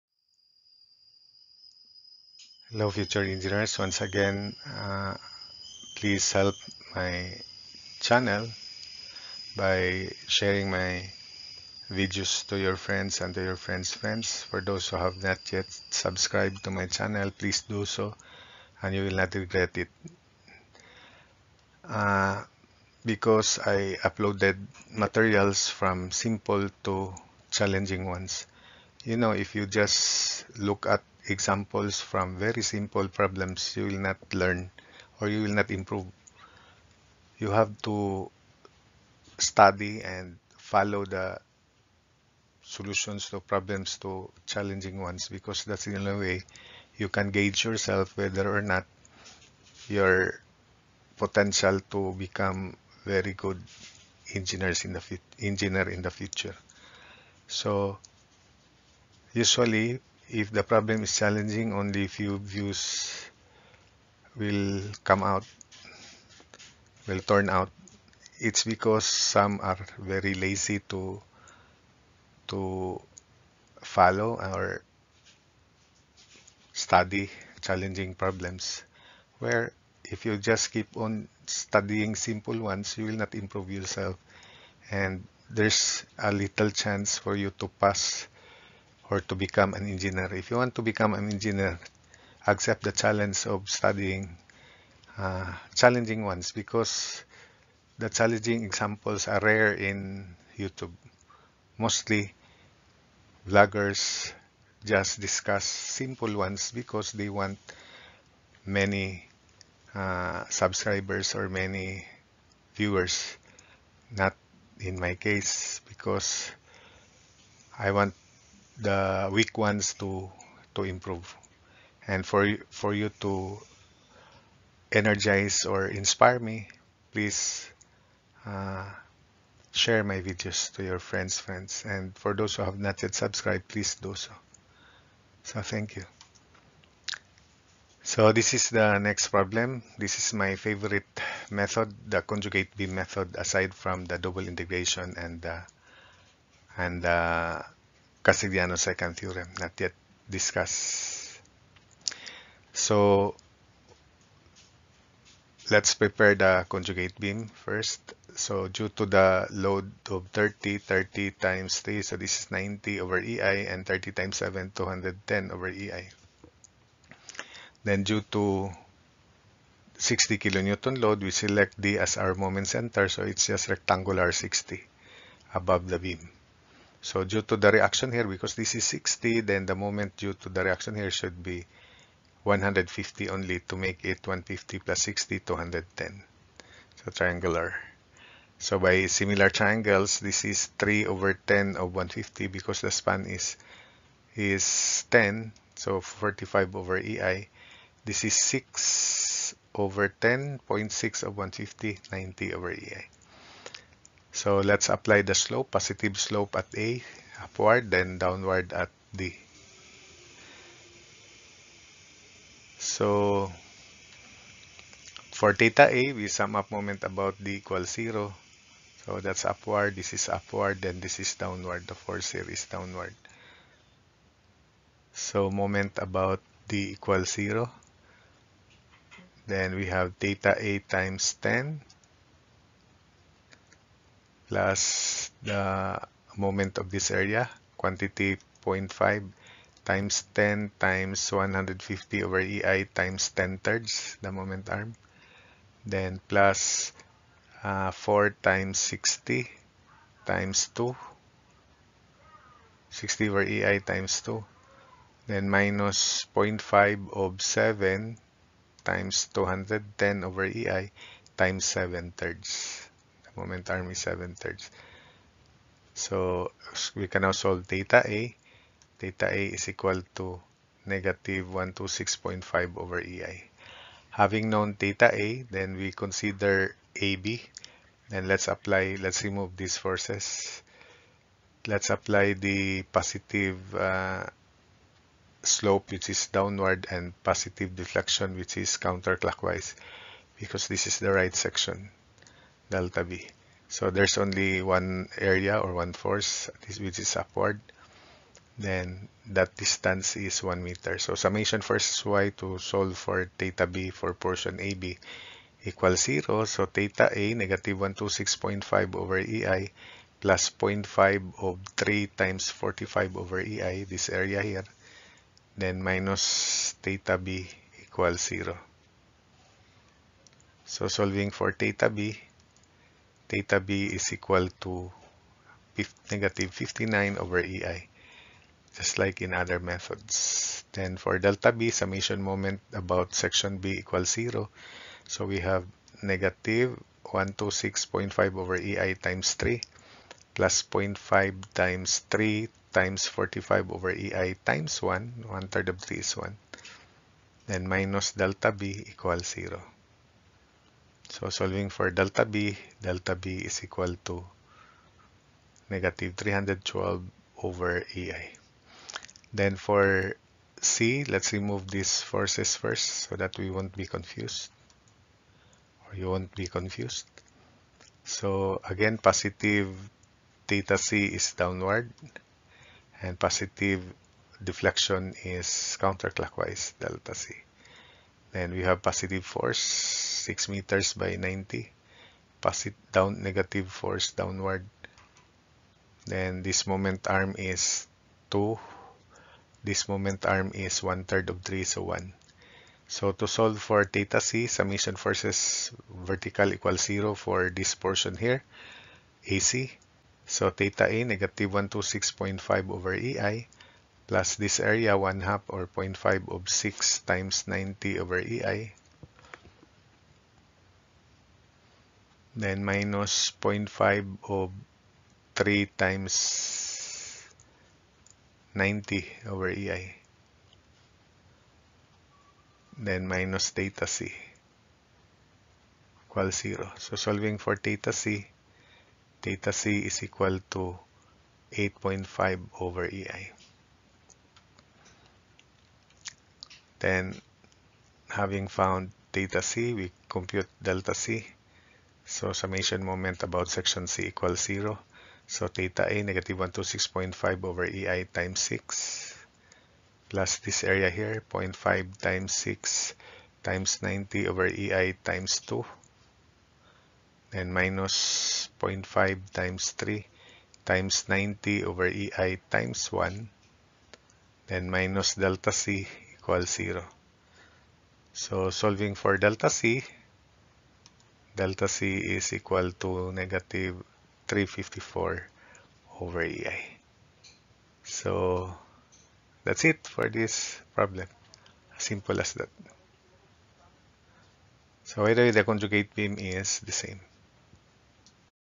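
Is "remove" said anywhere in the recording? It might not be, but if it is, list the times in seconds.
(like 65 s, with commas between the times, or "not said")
279 s, 361 s.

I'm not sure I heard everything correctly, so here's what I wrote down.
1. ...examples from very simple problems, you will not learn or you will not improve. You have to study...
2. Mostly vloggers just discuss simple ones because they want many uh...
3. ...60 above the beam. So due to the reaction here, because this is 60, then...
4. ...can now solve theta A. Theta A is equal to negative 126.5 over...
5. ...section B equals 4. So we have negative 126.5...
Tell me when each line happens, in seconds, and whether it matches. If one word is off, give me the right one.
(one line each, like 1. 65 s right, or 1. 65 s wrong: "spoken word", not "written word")
1. 31 s right
2. 101 s right
3. 174 s right
4. 267 s right
5. 333 s wrong: "0", not "4".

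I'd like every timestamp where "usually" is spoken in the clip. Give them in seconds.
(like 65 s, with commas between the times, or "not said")
59 s.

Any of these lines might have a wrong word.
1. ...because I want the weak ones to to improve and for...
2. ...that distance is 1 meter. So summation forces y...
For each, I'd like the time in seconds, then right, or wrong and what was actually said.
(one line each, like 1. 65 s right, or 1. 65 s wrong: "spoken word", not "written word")
1. 115 s right
2. 299 s right.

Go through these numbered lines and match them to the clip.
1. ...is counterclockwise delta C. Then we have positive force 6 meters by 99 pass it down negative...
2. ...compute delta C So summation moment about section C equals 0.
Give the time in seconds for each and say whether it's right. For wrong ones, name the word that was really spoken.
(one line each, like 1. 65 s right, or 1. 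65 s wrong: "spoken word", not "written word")
1. 375 s wrong: "90", not "99"
2. 440 s right.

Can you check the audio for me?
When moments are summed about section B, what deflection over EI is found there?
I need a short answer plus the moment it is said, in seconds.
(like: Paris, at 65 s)
-312, at 355 s.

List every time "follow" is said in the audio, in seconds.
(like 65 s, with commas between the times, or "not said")
40 s, 73 s.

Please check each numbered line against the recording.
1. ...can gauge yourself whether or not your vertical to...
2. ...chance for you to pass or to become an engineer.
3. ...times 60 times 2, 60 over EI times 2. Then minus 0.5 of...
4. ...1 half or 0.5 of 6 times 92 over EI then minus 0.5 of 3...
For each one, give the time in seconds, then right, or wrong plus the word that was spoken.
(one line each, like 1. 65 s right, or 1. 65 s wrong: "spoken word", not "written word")
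1. 47 s wrong: "potential", not "vertical"
2. 86 s right
3. 248 s right
4. 404 s wrong: "90", not "92".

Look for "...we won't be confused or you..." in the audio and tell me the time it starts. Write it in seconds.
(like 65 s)
363 s.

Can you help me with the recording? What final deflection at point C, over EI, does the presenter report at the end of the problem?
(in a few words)
-354.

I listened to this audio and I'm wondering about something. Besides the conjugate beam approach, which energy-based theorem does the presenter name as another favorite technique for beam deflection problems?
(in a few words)
Castigliano second theorem.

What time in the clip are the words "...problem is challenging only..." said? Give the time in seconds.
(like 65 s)
60 s.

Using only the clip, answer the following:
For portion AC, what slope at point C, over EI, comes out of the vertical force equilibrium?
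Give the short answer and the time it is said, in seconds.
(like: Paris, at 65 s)
8.5, at 431 s.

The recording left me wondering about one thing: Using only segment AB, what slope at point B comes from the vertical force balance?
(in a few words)
-59.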